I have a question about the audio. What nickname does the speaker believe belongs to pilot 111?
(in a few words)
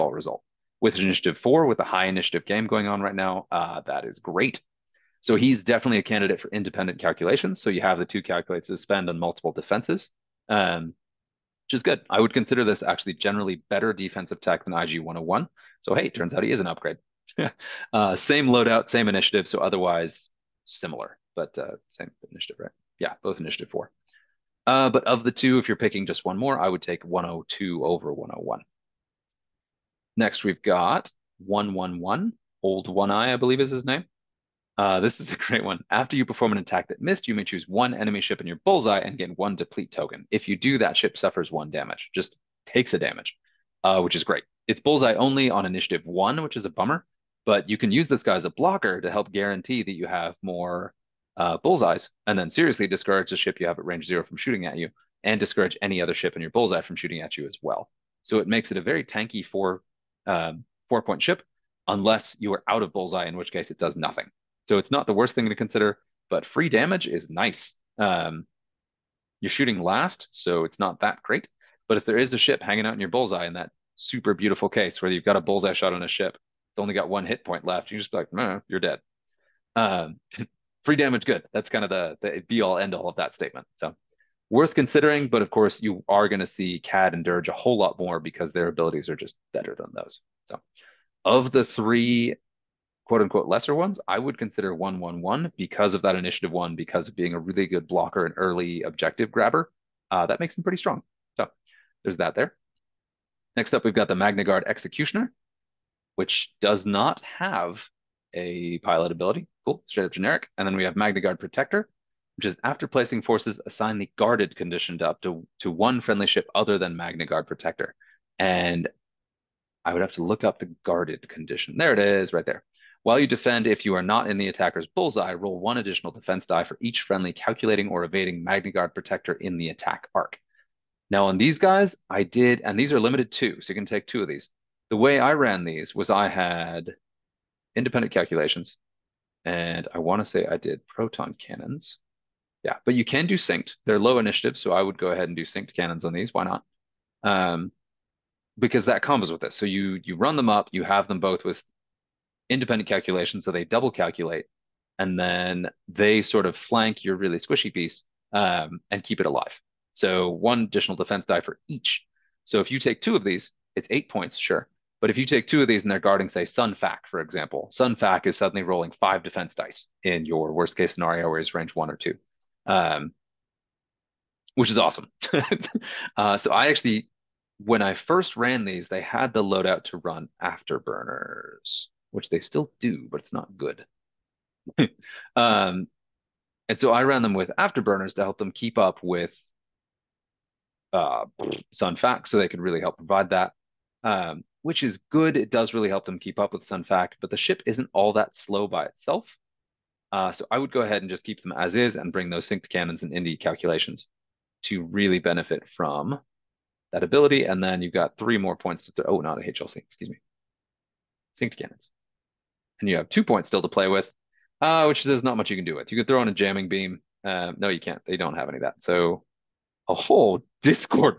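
Old One Eye.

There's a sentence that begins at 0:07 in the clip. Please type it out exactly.
So you have the two calculates to spend on multiple defenses, um, which is good.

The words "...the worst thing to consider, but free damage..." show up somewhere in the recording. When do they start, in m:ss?
1:05.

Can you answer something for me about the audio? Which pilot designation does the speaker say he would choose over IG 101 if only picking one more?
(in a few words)
102.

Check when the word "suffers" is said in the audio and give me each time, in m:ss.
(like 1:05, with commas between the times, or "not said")
0:41.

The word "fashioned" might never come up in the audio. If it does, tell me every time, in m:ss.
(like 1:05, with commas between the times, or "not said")
not said.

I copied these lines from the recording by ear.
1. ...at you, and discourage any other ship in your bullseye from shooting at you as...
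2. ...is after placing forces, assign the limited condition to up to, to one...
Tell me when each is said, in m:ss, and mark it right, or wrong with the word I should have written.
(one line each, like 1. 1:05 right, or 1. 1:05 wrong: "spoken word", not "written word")
1. 0:54 right
2. 1:52 wrong: "guarded", not "limited".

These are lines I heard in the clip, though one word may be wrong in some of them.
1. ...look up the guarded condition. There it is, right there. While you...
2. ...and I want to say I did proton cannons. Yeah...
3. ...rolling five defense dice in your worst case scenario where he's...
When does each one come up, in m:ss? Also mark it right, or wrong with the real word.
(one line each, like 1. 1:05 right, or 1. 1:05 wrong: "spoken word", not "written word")
1. 2:00 right
2. 2:19 right
3. 2:48 right.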